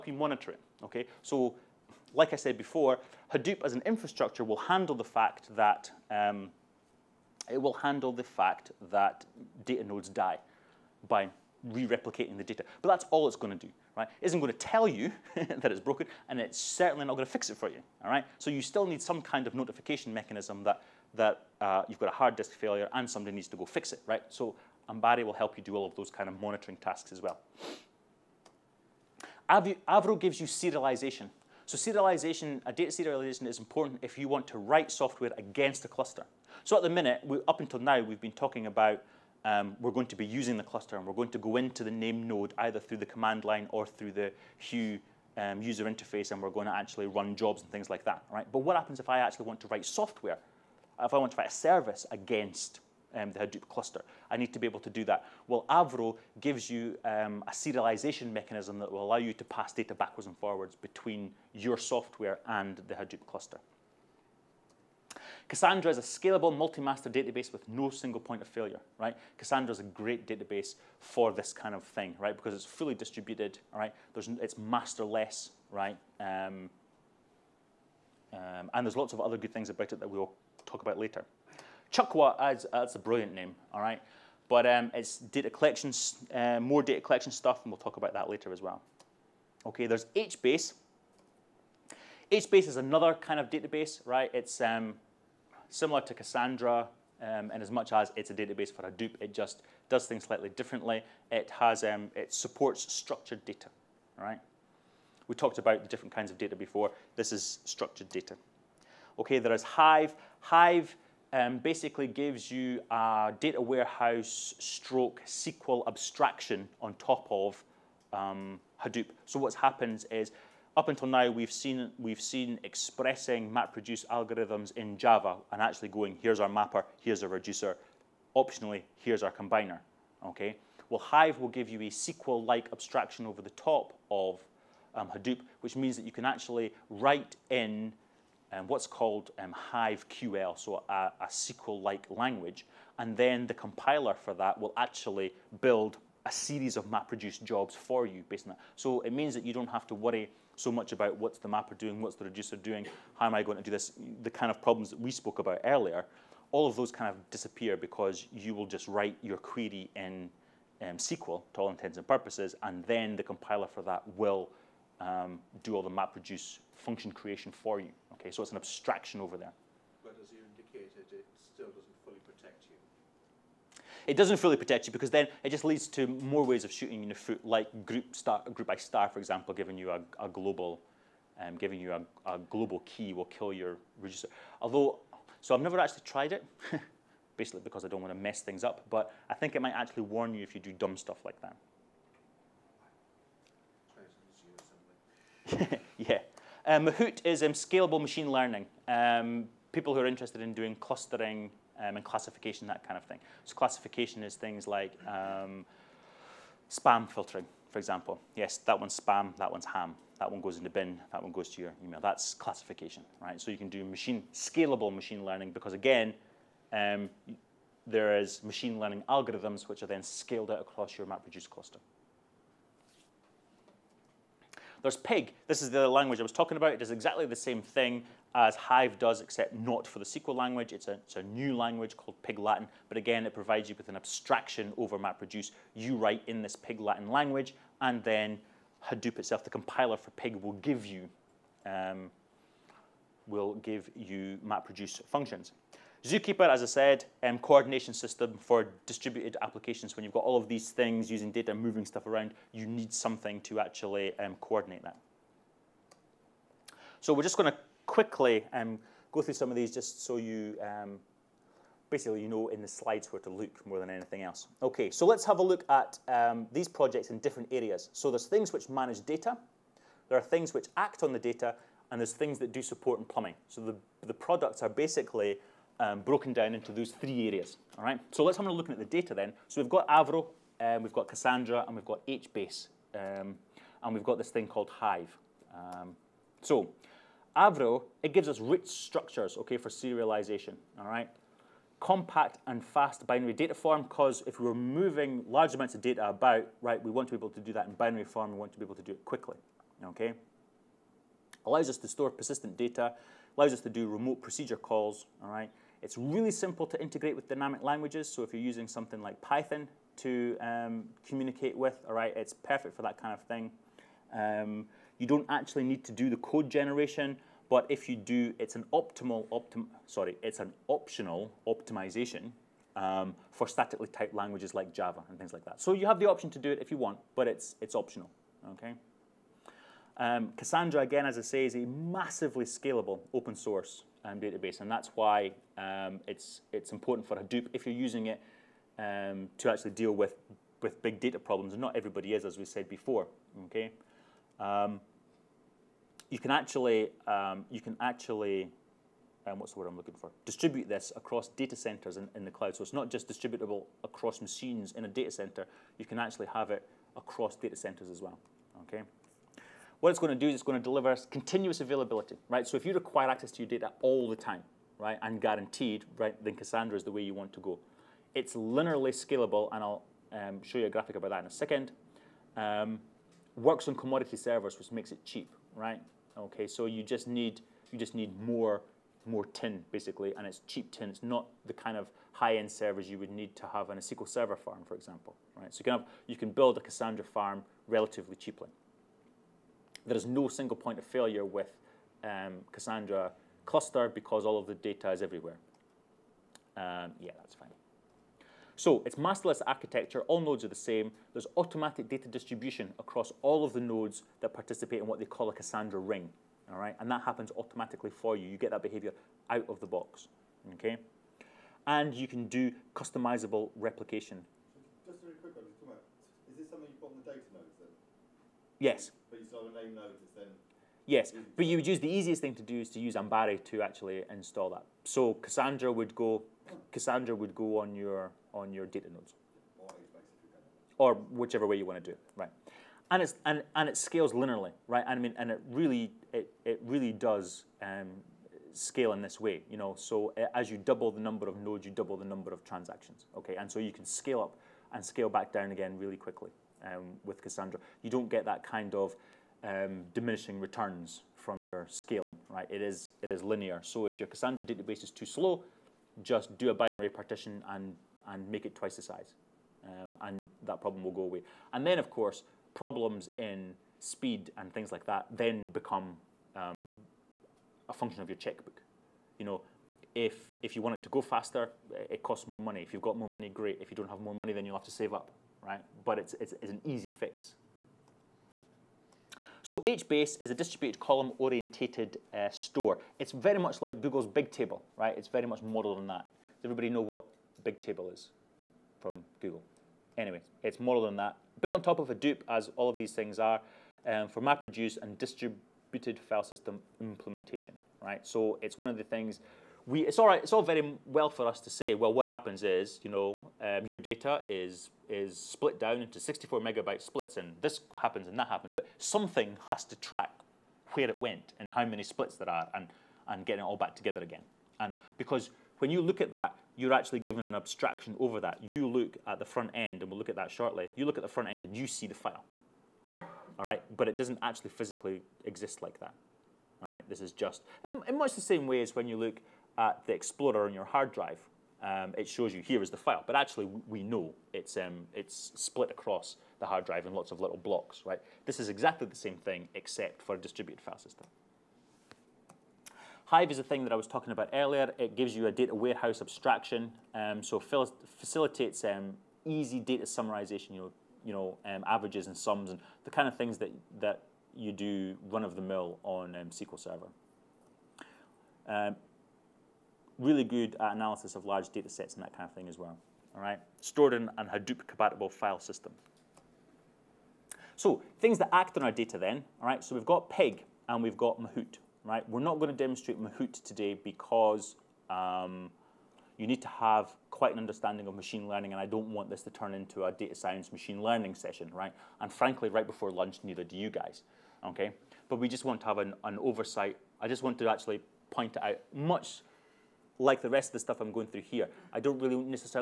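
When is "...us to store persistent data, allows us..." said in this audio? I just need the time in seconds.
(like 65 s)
301 s.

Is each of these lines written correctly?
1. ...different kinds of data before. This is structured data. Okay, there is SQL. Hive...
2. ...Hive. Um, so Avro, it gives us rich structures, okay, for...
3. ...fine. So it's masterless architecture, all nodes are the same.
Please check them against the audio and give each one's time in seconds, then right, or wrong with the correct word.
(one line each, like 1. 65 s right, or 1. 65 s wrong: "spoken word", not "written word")
1. 105 s wrong: "Hive", not "SQL"
2. 284 s right
3. 397 s right.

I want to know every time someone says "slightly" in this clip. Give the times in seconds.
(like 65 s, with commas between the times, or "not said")
100 s.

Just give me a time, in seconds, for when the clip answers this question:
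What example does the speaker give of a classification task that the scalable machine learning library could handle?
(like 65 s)
206 s.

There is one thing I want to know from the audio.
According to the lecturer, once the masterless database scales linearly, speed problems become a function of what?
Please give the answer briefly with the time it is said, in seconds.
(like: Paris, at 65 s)
your checkbook, at 468 s.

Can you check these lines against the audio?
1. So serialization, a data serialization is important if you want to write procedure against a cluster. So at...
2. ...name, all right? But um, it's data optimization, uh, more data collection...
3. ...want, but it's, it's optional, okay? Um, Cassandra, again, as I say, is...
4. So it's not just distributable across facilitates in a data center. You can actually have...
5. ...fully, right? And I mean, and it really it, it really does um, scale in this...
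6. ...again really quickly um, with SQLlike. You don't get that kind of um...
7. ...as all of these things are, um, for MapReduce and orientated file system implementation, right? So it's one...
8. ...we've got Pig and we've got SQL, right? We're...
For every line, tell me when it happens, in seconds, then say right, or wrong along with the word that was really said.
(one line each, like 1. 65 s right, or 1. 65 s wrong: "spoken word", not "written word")
1. 31 s wrong: "software", not "procedure"
2. 83 s wrong: "collection", not "optimization"
3. 326 s right
4. 352 s wrong: "machines", not "facilitates"
5. 434 s wrong: "linearly", not "fully"
6. 445 s wrong: "Cassandra", not "SQLlike"
7. 492 s wrong: "distributed", not "orientated"
8. 569 s wrong: "Mahout", not "SQL".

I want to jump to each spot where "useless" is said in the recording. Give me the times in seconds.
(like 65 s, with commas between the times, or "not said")
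not said.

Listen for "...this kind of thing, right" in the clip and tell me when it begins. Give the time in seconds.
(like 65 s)
71 s.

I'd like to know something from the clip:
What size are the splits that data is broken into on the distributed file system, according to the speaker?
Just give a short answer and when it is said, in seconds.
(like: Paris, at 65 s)
64 megabytes, at 506 s.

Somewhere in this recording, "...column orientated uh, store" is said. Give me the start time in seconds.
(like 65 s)
480 s.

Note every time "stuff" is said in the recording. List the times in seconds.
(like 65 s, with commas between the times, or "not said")
87 s, 190 s, 251 s, 590 s.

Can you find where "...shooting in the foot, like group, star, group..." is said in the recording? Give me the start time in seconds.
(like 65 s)
176 s.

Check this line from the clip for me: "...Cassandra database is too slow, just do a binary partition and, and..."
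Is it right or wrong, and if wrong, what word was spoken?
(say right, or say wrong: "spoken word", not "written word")
right.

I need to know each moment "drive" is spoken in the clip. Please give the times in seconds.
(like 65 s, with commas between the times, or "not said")
530 s, 536 s.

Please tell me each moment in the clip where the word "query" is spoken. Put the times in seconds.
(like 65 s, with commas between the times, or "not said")
159 s.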